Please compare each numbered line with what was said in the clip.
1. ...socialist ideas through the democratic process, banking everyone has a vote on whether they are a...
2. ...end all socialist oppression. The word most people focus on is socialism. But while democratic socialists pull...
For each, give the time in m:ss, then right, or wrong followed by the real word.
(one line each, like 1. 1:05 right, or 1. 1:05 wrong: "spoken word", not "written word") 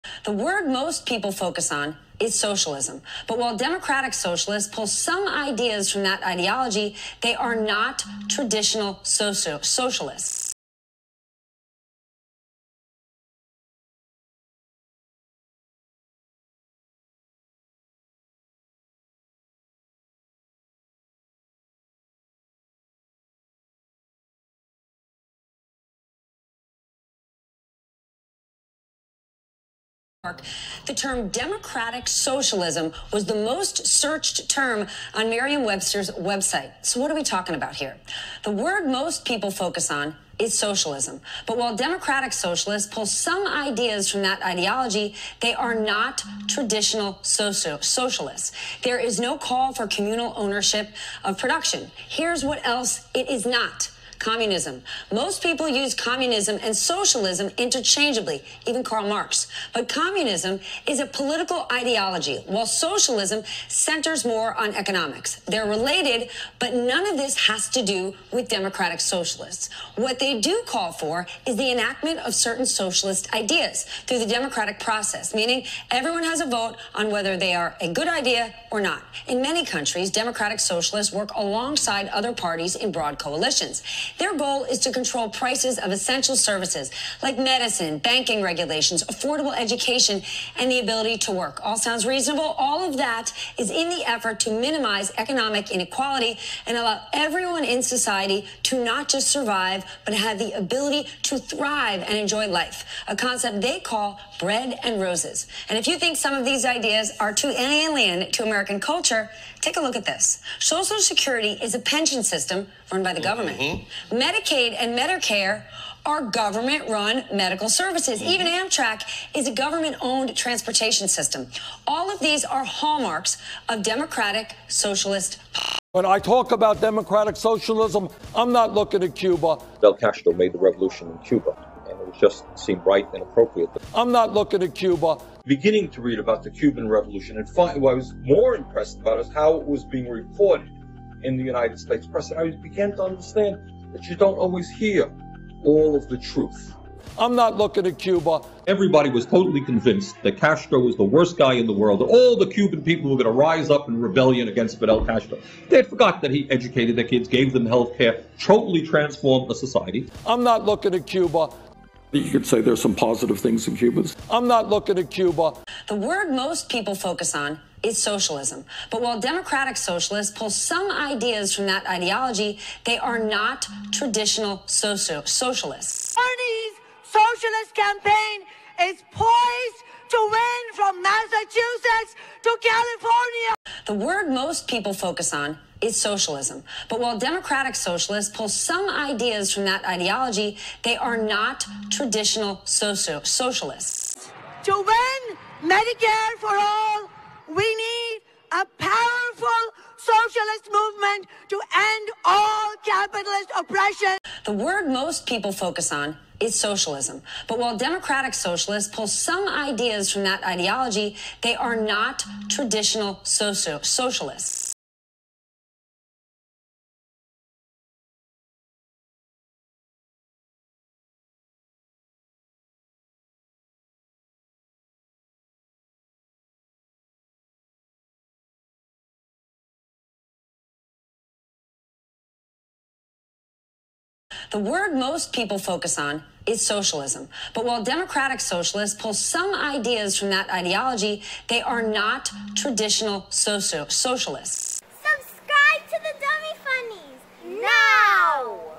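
1. 1:12 wrong: "meaning", not "banking"
2. 3:21 wrong: "capitalist", not "socialist".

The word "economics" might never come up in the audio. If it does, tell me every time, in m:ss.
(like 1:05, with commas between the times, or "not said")
1:04, 1:35.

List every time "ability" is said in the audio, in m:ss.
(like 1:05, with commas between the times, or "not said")
1:30, 1:40.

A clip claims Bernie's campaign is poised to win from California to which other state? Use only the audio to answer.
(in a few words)
Massachusetts.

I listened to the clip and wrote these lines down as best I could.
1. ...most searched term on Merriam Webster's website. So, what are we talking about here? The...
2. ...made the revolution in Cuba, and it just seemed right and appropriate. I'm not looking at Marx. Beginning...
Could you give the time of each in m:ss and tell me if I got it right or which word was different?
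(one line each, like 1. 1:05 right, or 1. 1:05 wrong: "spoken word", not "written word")
1. 0:33 right
2. 2:10 wrong: "Cuba", not "Marx".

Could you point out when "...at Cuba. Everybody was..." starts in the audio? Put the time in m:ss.
2:27.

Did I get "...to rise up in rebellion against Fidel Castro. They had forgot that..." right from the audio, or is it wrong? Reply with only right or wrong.
right.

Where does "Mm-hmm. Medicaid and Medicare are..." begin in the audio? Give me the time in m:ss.
1:53.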